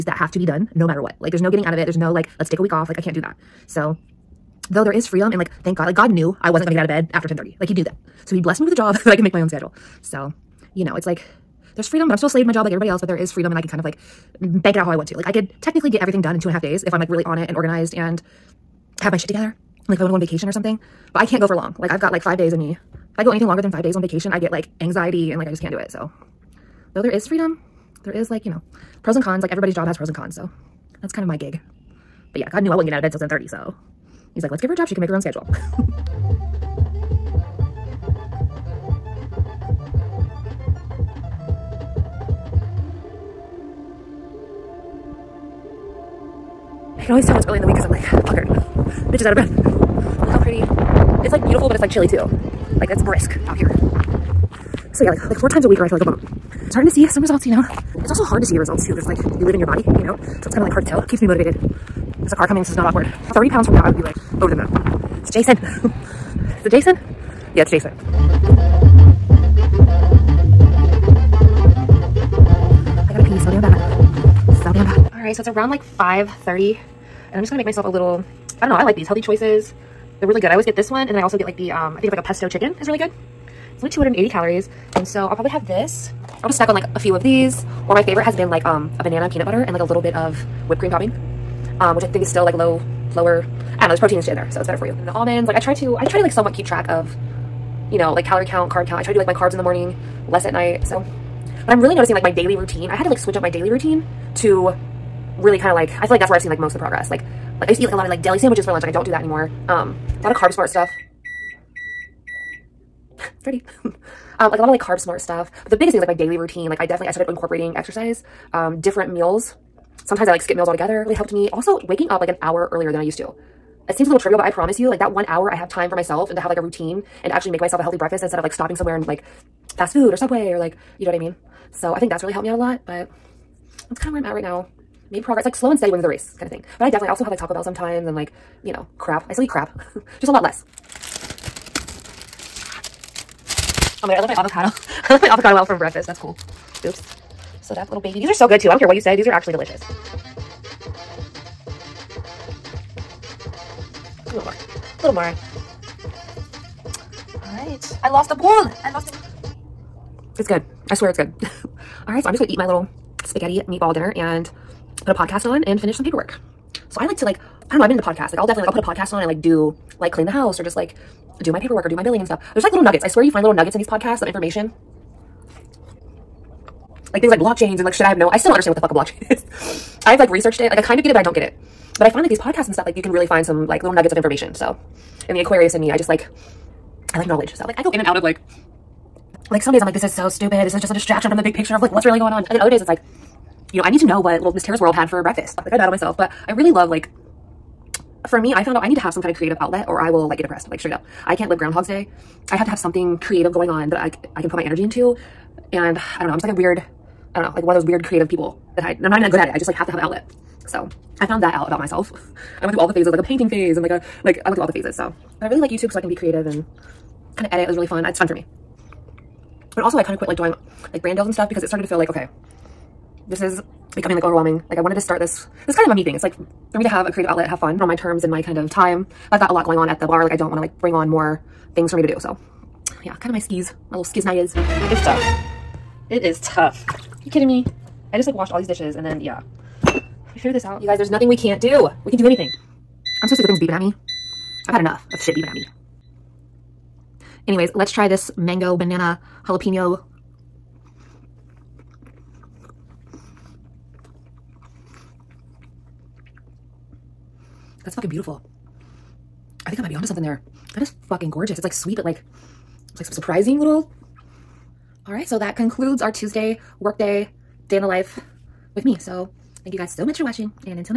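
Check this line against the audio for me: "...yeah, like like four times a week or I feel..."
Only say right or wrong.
right.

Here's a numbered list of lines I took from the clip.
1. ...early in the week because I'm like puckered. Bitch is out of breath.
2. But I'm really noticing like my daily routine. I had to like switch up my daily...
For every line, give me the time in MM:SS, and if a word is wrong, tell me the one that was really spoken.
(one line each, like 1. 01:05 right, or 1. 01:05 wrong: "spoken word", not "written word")
1. 00:47 right
2. 01:41 right.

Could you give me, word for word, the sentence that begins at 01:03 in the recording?
30 pounds from now, I would be like over the moon.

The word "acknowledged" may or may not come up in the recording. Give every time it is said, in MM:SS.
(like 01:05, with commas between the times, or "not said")
not said.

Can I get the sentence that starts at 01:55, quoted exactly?
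But the biggest thing is like my daily routine.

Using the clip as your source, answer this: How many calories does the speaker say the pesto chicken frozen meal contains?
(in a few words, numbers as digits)
280.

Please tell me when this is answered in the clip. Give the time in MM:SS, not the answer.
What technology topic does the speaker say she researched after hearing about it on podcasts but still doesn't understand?
02:58.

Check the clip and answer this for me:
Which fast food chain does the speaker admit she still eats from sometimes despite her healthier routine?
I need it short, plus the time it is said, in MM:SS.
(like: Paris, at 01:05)
Taco Bell, at 02:17.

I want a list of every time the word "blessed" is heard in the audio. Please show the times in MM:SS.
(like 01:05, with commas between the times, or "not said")
00:08.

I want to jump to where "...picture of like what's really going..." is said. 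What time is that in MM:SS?
03:11.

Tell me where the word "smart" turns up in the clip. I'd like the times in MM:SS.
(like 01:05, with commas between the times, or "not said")
01:50, 01:54.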